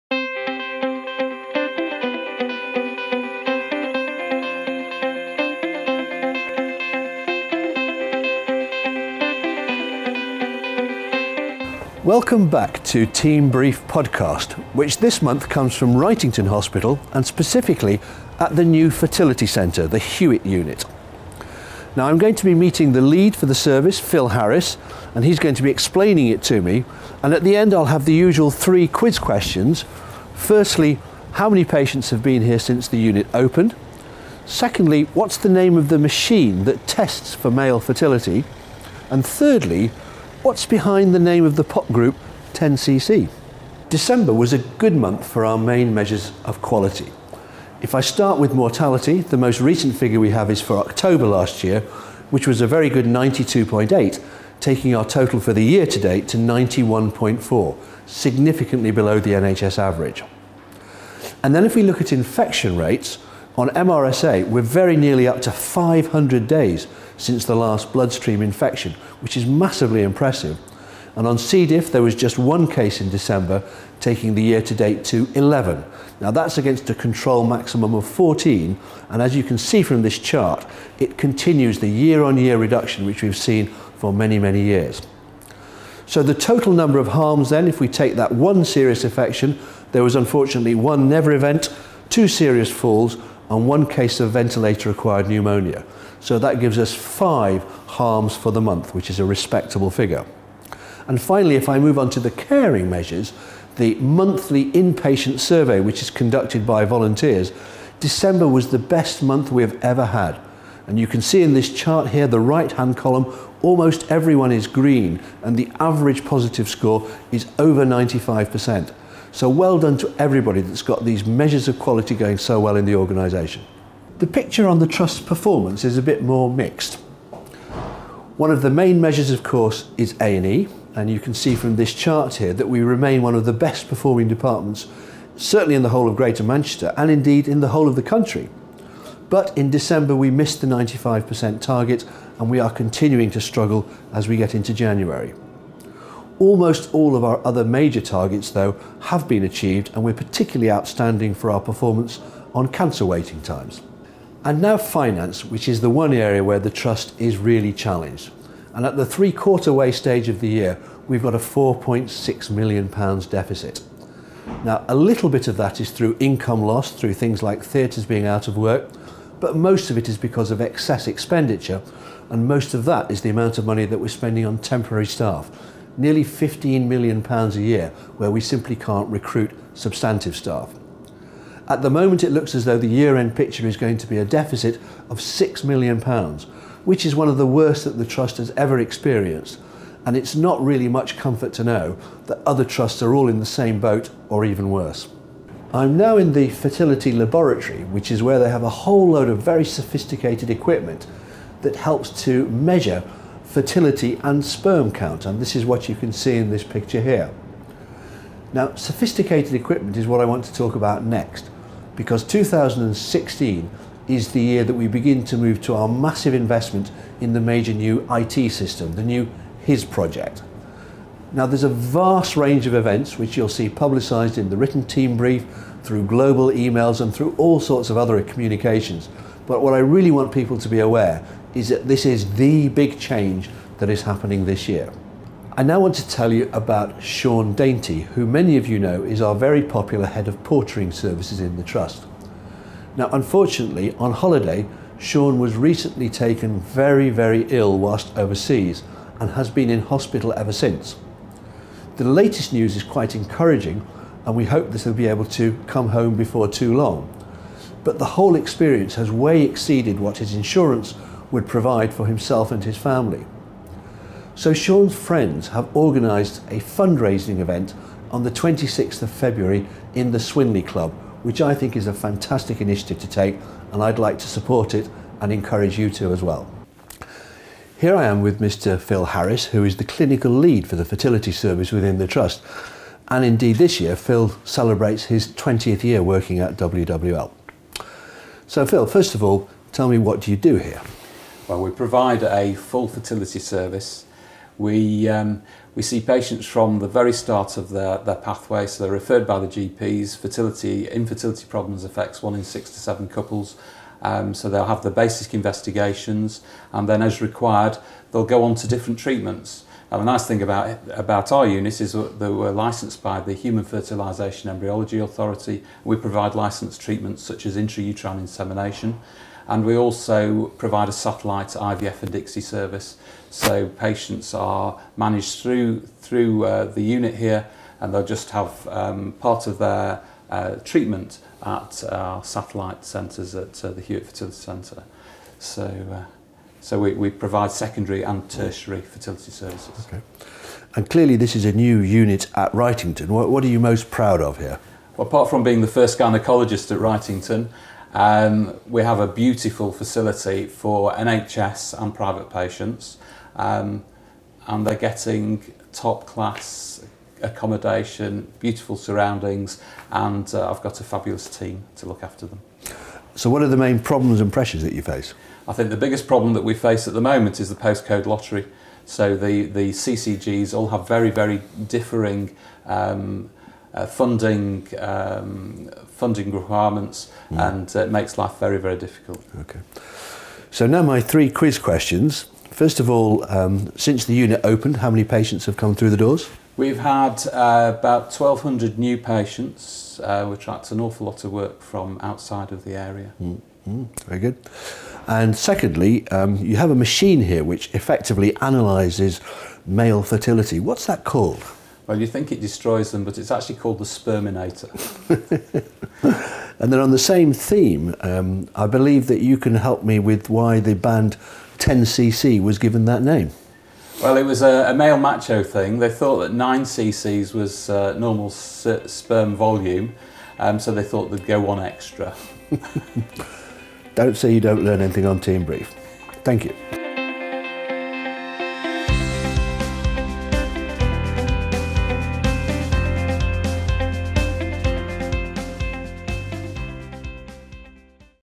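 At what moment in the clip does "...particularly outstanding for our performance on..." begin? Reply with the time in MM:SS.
02:30.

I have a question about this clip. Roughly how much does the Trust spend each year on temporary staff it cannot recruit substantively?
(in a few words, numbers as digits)
15 million pounds.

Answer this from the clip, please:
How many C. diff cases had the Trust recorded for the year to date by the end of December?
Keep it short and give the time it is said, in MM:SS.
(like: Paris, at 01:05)
11, at 01:15.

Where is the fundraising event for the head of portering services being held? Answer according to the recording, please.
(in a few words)
Swinley Club.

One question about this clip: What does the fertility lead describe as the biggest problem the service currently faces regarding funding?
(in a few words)
postcode lottery.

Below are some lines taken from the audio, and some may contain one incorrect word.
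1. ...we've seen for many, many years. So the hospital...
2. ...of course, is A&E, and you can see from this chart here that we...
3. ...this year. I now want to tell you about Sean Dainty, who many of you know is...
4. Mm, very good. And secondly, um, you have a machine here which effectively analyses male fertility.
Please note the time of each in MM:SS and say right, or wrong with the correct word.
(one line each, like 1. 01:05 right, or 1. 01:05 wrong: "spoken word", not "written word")
1. 01:23 wrong: "total", not "hospital"
2. 02:09 right
3. 03:54 right
4. 06:33 right.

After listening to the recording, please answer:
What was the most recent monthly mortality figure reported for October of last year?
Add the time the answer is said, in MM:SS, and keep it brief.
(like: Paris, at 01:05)
92.8, at 00:53.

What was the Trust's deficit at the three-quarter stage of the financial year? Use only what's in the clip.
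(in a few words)
£4.6 million.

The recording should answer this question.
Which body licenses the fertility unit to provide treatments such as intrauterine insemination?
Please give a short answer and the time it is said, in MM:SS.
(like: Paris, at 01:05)
Human Fertilisation Embryology Authority, at 05:13.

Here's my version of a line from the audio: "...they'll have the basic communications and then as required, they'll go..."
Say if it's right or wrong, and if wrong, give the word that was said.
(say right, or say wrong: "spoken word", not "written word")
wrong: "investigations", not "communications".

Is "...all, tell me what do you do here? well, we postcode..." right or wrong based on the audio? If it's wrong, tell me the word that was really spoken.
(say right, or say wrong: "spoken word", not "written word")
wrong: "provide", not "postcode".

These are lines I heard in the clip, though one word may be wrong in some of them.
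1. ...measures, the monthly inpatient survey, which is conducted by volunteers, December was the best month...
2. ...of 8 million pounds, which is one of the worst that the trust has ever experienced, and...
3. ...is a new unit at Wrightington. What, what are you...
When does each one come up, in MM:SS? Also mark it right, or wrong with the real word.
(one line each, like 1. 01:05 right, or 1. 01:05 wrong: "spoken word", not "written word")
1. 01:42 right
2. 03:05 wrong: "6", not "8"
3. 05:41 right.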